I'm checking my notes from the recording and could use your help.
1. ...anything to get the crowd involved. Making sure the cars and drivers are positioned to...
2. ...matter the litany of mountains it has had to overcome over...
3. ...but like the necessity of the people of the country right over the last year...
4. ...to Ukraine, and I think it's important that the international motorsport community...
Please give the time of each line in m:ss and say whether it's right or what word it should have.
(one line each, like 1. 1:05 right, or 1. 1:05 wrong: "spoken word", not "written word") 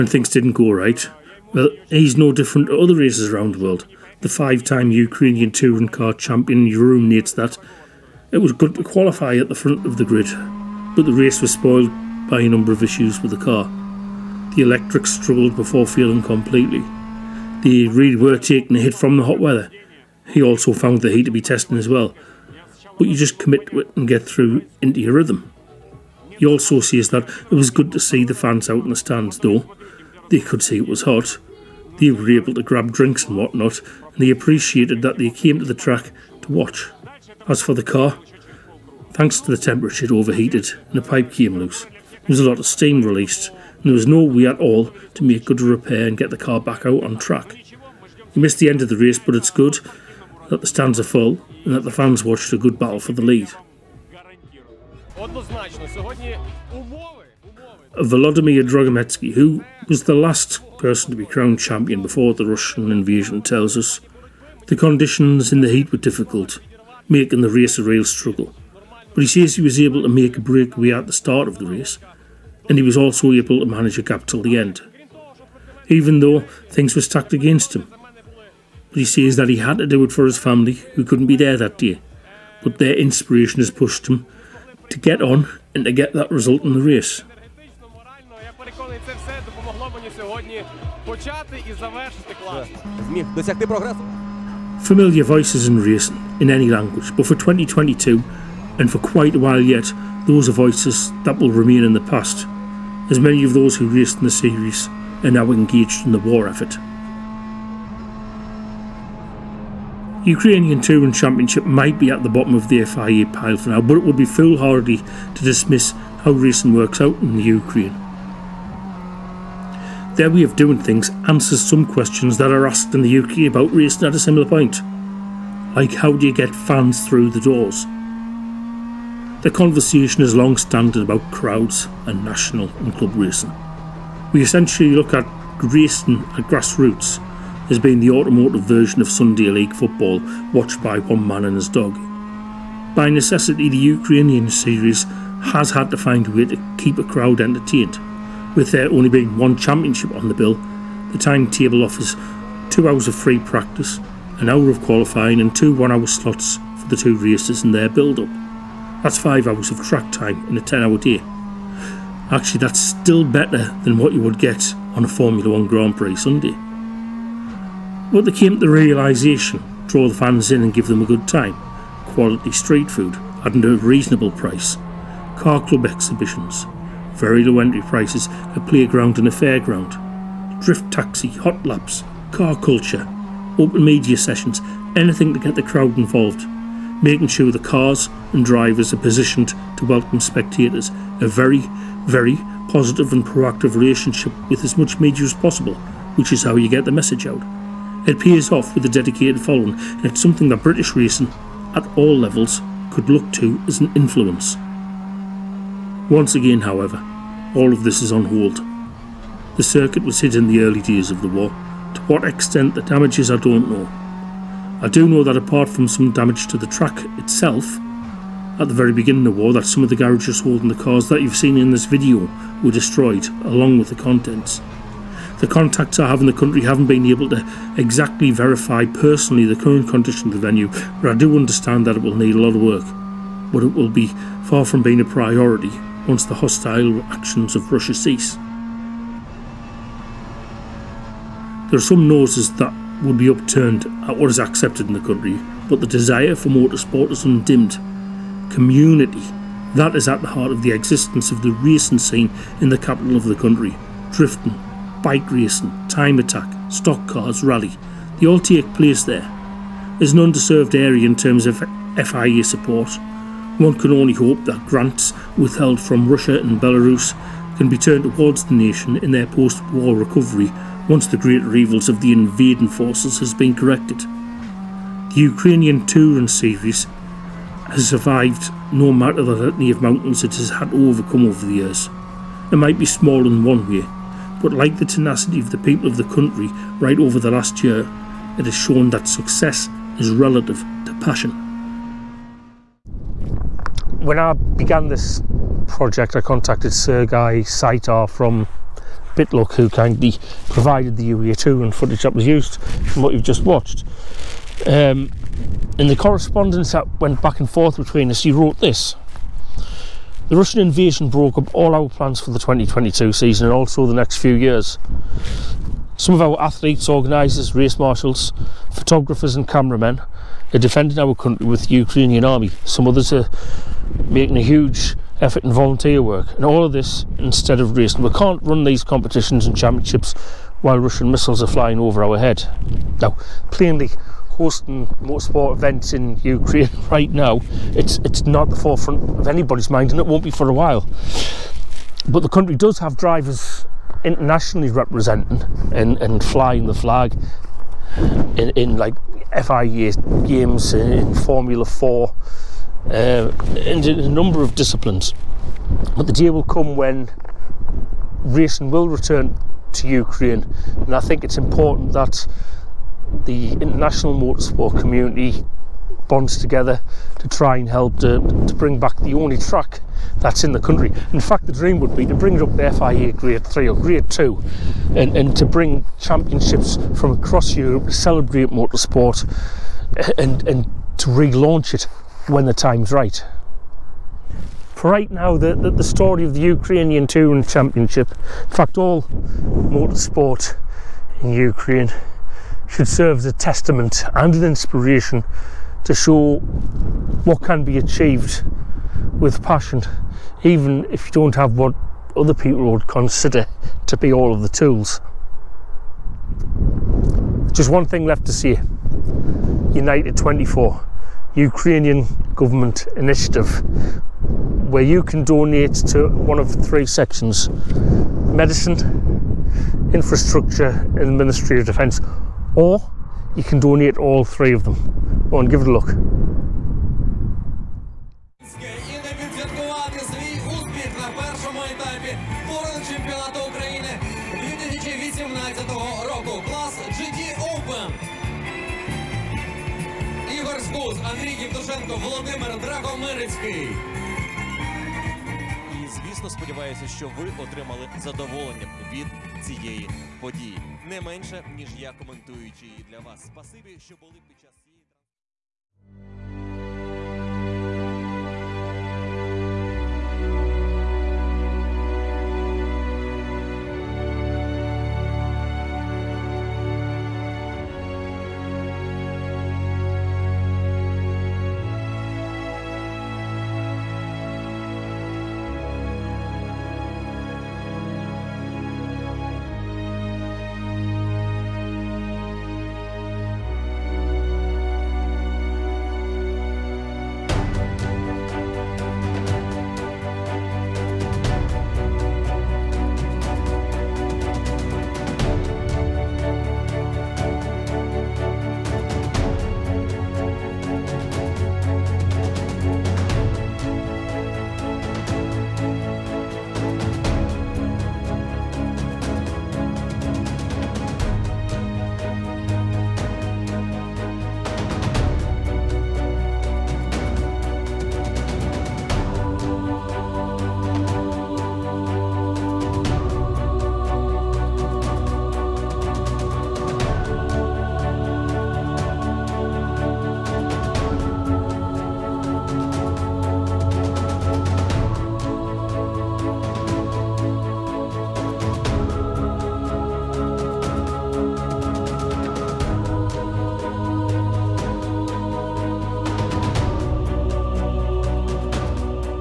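1. 3:04 right
2. 4:38 right
3. 4:44 wrong: "tenacity", not "necessity"
4. 5:59 right.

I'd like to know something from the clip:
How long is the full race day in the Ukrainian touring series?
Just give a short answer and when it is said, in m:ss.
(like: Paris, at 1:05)
10 hours, at 2:40.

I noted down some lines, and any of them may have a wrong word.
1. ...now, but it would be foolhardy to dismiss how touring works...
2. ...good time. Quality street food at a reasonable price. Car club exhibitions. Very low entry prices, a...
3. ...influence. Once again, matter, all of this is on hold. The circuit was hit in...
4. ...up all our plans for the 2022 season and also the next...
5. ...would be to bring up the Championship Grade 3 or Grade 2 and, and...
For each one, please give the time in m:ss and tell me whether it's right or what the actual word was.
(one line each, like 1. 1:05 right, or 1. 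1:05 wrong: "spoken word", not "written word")
1. 1:53 wrong: "racing", not "touring"
2. 2:51 right
3. 3:23 wrong: "however", not "matter"
4. 5:11 right
5. 6:11 wrong: "FIA", not "Championship".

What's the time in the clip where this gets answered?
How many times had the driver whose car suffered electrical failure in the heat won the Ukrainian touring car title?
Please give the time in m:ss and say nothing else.
0:04.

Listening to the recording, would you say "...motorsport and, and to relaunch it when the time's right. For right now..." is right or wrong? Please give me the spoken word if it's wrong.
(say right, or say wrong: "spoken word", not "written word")
right.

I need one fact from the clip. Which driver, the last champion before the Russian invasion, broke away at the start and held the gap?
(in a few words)
Volodymyr Dragometsky.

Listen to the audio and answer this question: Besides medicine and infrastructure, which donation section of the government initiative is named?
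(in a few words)
Ministry of Defence.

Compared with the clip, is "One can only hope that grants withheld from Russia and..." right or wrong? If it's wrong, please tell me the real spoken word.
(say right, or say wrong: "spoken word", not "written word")
right.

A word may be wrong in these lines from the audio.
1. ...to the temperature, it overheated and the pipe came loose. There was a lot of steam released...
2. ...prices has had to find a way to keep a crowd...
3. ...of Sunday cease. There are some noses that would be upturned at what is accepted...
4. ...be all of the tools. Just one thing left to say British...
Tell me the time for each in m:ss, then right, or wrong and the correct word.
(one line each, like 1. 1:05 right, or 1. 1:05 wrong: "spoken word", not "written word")
1. 0:39 right
2. 2:24 wrong: "series", not "prices"
3. 3:57 wrong: "Russia", not "Sunday"
4. 6:43 wrong: "United", not "British".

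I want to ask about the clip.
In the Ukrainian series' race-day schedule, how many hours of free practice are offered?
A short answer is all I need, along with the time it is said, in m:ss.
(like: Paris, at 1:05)
2, at 2:32.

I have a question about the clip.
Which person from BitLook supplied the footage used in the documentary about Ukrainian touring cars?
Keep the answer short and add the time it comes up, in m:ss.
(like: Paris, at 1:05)
Sergei Saitar, at 4:56.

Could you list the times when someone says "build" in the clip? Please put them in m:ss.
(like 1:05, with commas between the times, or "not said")
2:37.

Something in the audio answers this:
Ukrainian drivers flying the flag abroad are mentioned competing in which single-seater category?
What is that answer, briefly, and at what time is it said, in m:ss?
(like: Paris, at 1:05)
Formula Four, at 5:51.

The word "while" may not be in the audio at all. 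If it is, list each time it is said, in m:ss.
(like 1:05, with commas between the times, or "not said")
1:39, 5:30, 5:40.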